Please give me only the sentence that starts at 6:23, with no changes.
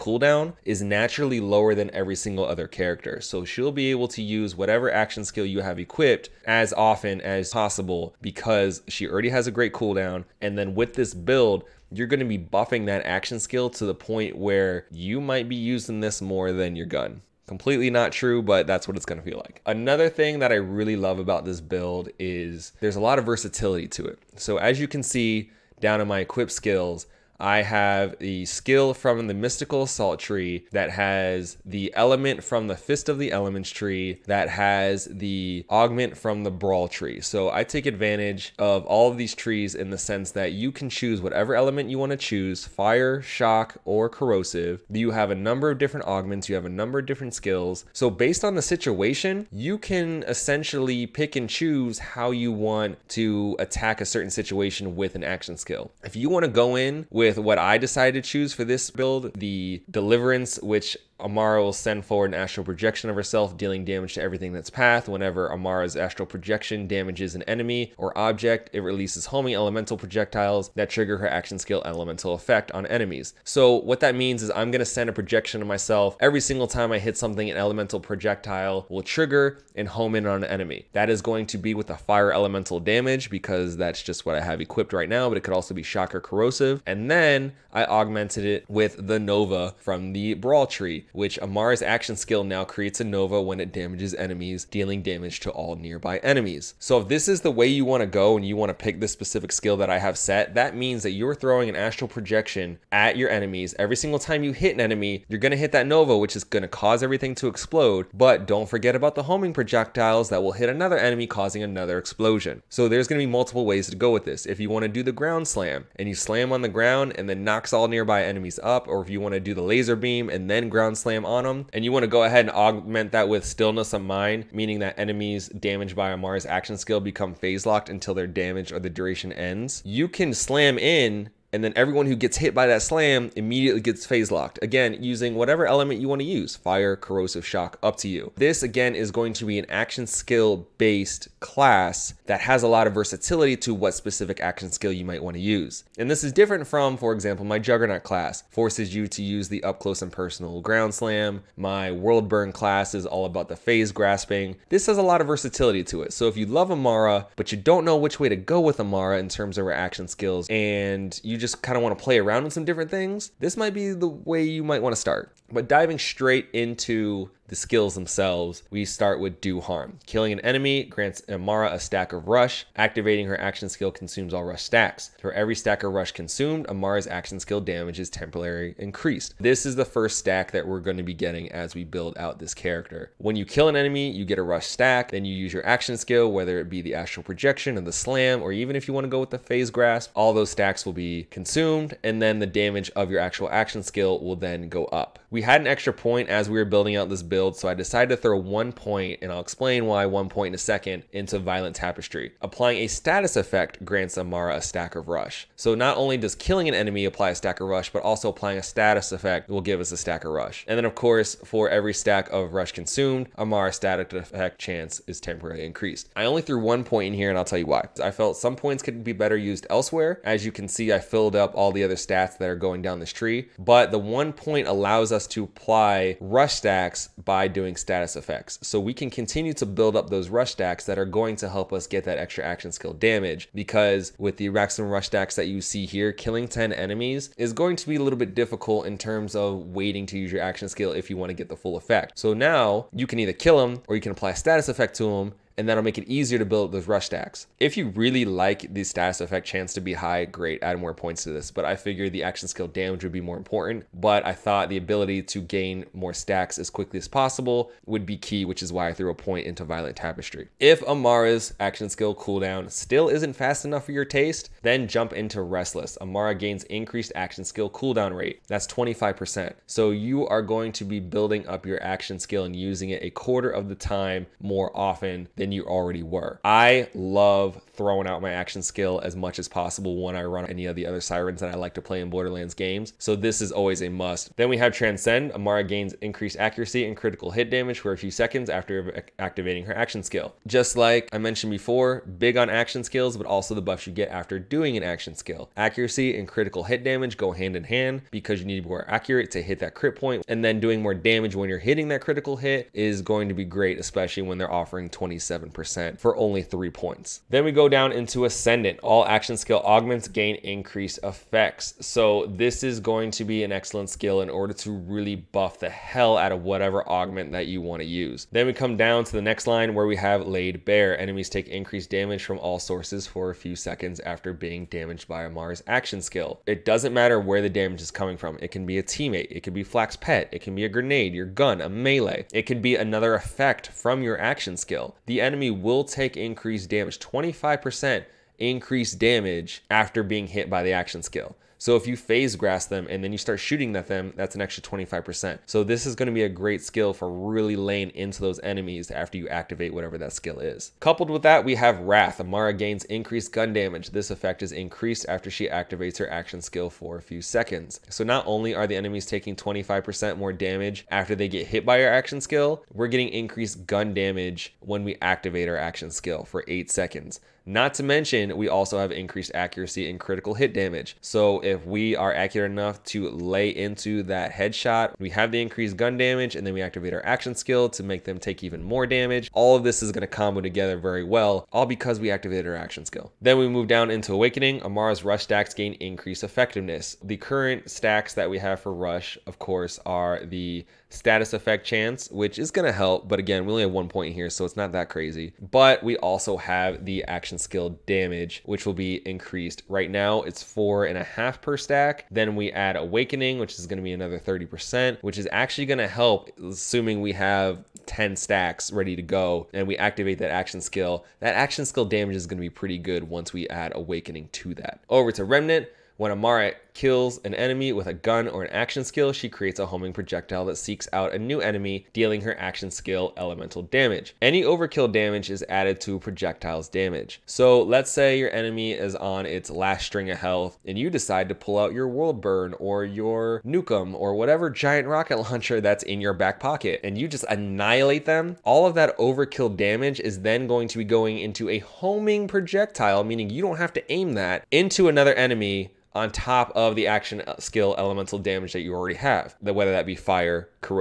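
Then we move down into Awakening, Amara's Rush stacks gain increased effectiveness.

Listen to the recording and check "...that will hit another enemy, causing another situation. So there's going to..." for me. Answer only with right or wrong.
wrong.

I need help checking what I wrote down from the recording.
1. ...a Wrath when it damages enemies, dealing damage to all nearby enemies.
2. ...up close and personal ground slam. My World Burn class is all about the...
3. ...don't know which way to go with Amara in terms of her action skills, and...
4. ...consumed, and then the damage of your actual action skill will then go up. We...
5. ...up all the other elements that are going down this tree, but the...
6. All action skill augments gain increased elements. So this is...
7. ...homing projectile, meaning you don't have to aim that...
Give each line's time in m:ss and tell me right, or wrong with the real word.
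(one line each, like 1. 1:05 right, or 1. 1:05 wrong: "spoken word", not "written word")
1. 1:32 wrong: "Nova", not "Wrath"
2. 2:29 right
3. 2:37 right
4. 3:11 right
5. 3:41 wrong: "stats", not "elements"
6. 5:08 wrong: "effects", not "elements"
7. 7:21 right.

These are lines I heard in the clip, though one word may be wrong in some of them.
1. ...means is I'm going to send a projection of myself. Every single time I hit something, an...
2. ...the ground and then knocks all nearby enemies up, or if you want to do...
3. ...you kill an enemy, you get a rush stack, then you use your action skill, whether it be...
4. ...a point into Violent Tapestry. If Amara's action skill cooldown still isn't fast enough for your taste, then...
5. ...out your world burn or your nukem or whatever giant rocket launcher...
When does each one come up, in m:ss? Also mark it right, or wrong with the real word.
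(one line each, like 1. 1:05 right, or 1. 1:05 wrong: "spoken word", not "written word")
1. 1:14 right
2. 1:56 right
3. 3:03 right
4. 4:19 right
5. 7:11 right.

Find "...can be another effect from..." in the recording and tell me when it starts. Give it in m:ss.
5:32.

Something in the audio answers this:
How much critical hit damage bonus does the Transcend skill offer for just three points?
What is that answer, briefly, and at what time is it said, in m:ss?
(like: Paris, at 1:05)
27%, at 5:04.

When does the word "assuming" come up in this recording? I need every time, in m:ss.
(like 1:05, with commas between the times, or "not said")
6:46.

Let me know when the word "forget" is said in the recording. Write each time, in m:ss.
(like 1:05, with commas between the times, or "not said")
1:48.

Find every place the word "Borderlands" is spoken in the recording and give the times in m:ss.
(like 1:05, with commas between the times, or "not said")
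4:42.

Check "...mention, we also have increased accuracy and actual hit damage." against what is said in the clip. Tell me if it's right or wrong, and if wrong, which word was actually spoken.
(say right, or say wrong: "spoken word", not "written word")
wrong: "critical", not "actual".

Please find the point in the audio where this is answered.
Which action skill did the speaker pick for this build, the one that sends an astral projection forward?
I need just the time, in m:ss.
0:59.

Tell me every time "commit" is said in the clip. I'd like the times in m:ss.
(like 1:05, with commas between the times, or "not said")
not said.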